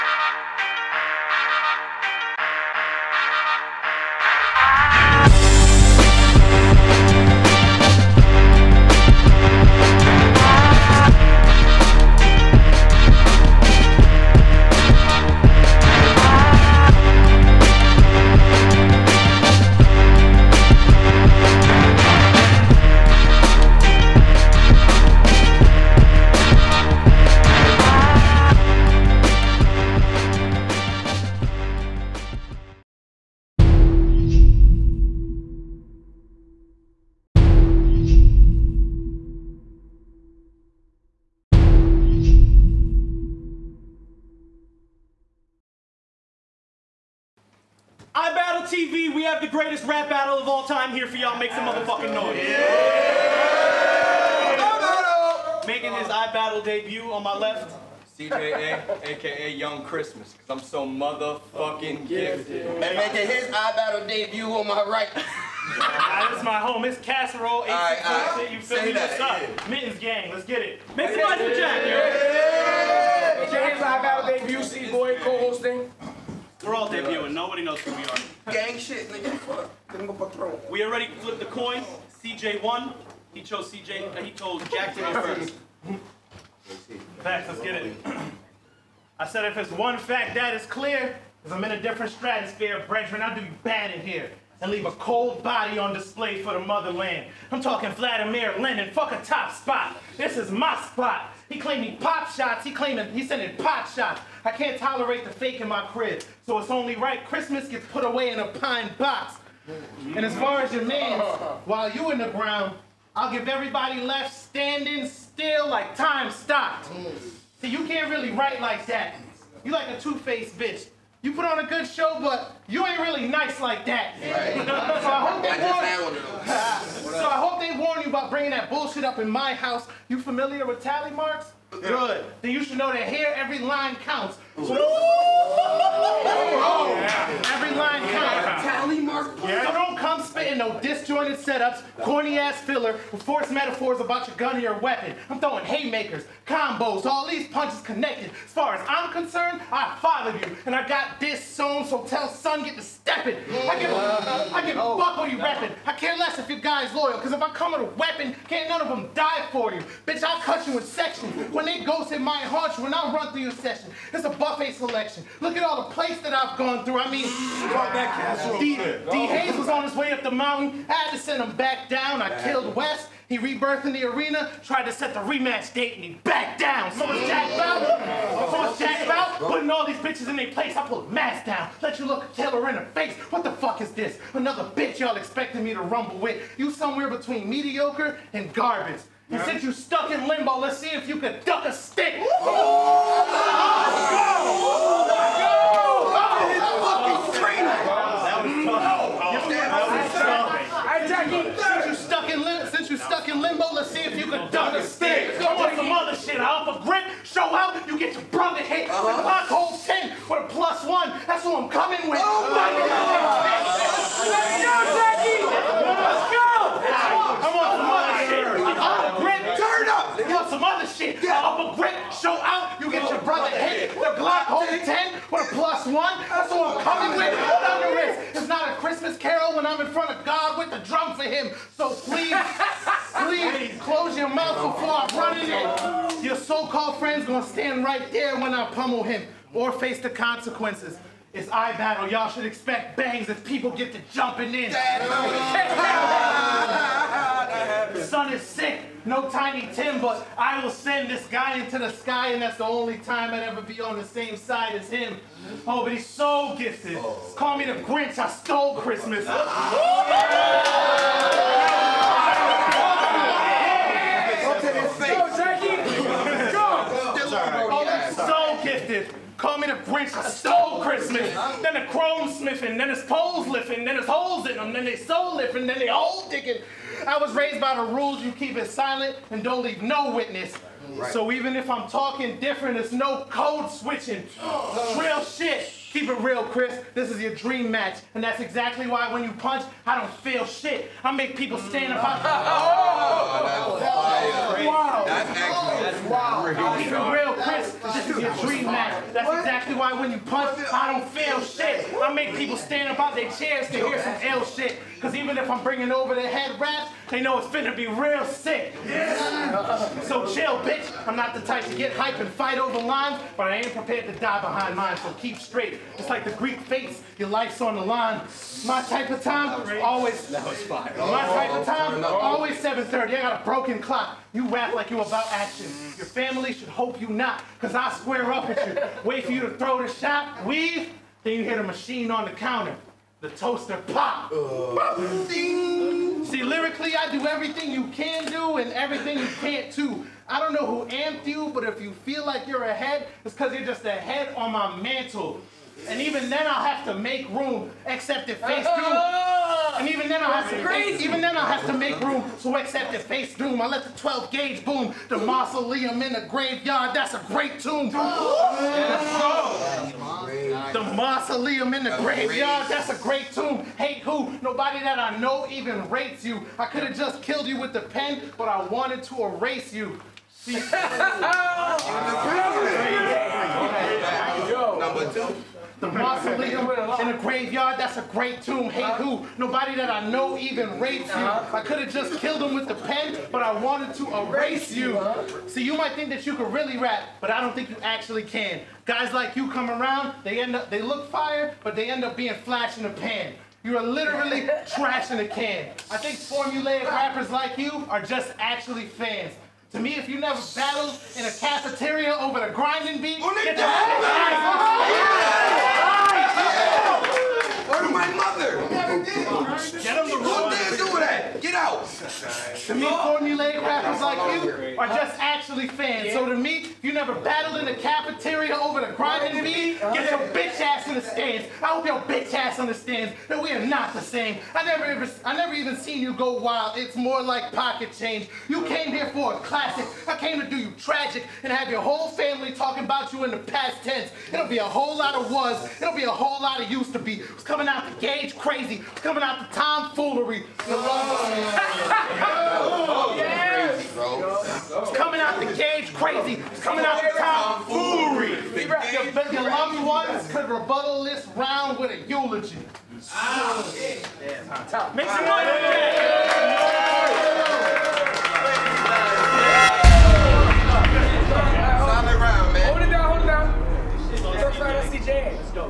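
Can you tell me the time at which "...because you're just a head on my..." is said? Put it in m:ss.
5:43.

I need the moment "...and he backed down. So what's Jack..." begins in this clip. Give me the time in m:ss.
2:55.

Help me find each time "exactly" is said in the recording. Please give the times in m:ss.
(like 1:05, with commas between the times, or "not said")
4:48, 4:59.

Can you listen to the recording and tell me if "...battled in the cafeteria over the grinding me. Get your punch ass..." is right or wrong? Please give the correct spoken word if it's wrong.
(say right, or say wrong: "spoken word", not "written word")
wrong: "bitch", not "punch".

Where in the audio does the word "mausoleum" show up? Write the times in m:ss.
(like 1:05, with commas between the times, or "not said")
5:55, 6:00, 6:15.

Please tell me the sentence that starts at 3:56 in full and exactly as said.
Your so-called friend's gonna stand right there when I pummel him or face the consequences.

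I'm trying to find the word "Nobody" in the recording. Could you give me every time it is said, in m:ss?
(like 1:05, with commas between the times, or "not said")
1:17, 6:04, 6:19.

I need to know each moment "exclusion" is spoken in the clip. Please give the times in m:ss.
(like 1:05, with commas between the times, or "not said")
not said.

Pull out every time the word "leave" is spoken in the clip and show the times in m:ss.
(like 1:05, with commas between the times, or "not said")
1:34, 4:39.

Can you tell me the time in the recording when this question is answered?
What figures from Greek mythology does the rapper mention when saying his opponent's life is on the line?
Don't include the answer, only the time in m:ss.
5:16.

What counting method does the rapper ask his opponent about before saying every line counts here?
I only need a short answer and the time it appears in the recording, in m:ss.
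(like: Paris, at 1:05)
tally marks, at 2:10.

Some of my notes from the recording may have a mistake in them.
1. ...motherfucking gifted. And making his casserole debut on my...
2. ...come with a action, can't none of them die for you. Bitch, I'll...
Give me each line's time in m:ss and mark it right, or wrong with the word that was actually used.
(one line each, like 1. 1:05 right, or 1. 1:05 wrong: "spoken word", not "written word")
1. 1:00 wrong: "iBattle", not "casserole"
2. 2:37 wrong: "weapon", not "action".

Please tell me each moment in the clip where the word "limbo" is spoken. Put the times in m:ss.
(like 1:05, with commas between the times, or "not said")
3:10, 3:23.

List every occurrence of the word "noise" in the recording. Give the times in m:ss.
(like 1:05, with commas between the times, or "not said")
0:52, 1:11, 7:36.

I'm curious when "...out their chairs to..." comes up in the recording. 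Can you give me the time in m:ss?
5:02.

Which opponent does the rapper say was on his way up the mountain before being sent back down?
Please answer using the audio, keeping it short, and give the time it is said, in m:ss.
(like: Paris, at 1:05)
D Hayes, at 2:49.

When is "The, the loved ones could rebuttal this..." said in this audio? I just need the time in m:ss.
7:28.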